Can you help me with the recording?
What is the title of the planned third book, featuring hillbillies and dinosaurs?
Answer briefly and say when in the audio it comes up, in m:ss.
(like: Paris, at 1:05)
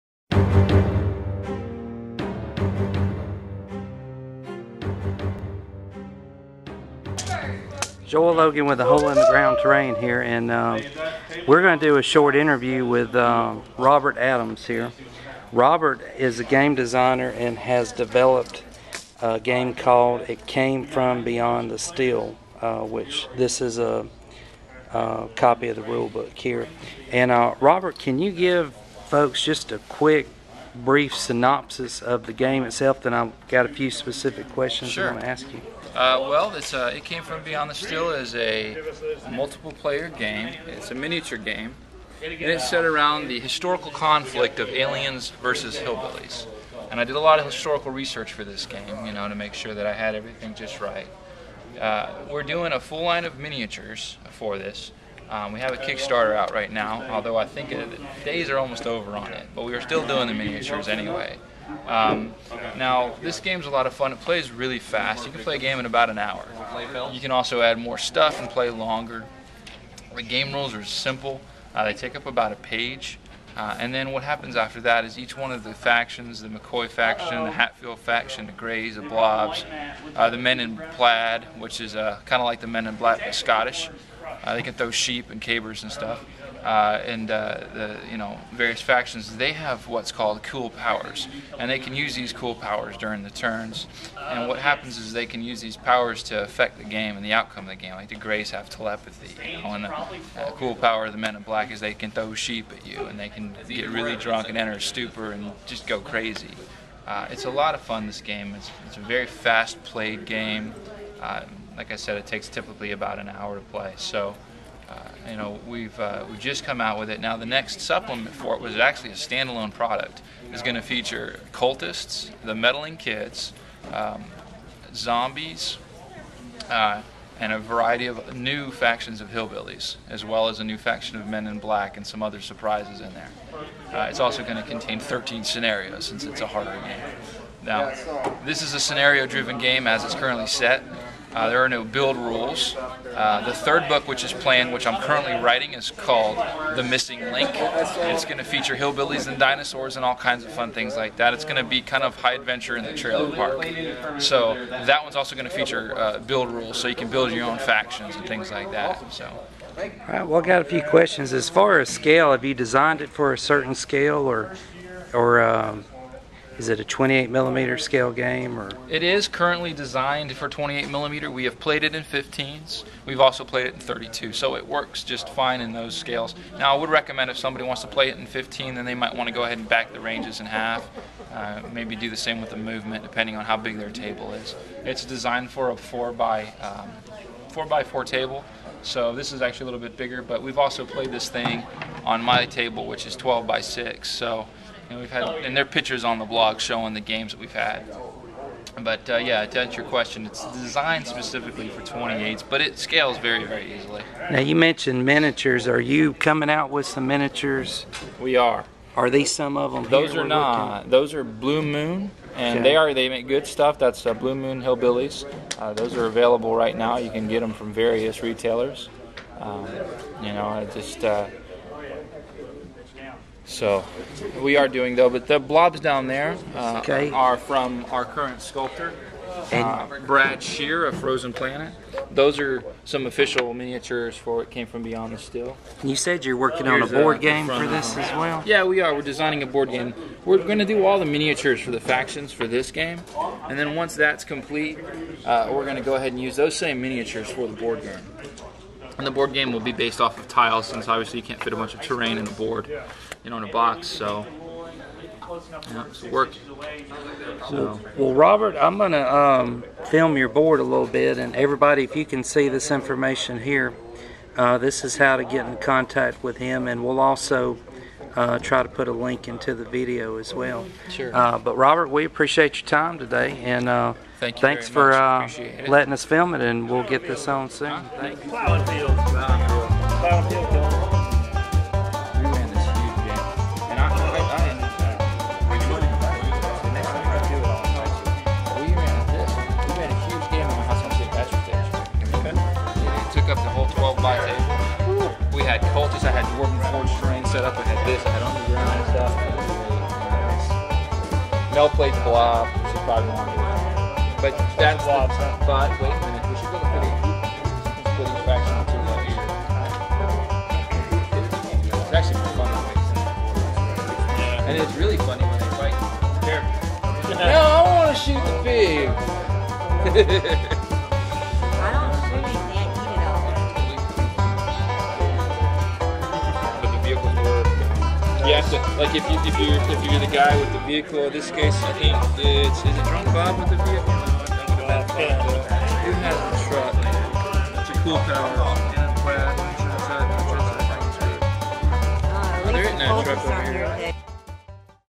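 The Missing Link, at 2:26.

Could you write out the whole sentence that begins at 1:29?
They have what's called cool powers, and they can use these cool powers during the turns.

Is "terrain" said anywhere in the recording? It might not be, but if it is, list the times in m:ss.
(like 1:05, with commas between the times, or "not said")
0:09, 4:11.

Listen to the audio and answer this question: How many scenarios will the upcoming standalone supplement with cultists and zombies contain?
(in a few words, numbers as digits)
13.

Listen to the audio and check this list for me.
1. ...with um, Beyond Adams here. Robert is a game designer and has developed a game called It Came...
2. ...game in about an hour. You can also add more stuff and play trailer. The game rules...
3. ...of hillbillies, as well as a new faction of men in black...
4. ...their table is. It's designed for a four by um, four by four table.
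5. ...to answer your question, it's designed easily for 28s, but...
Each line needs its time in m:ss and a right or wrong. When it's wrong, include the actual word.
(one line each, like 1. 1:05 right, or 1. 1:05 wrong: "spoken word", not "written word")
1. 0:12 wrong: "Robert", not "Beyond"
2. 1:05 wrong: "longer", not "trailer"
3. 2:09 right
4. 3:03 right
5. 3:19 wrong: "specifically", not "easily".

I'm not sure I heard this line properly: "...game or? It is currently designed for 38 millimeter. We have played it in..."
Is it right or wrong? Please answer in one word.
wrong.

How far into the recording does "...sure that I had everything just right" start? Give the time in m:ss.
0:49.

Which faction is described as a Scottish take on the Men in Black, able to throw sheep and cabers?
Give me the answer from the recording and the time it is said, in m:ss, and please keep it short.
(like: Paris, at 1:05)
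Men in Plaid, at 1:20.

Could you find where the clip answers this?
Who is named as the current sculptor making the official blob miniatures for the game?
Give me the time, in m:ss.
3:50.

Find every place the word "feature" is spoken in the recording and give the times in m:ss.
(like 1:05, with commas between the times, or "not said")
2:00, 2:28, 2:35.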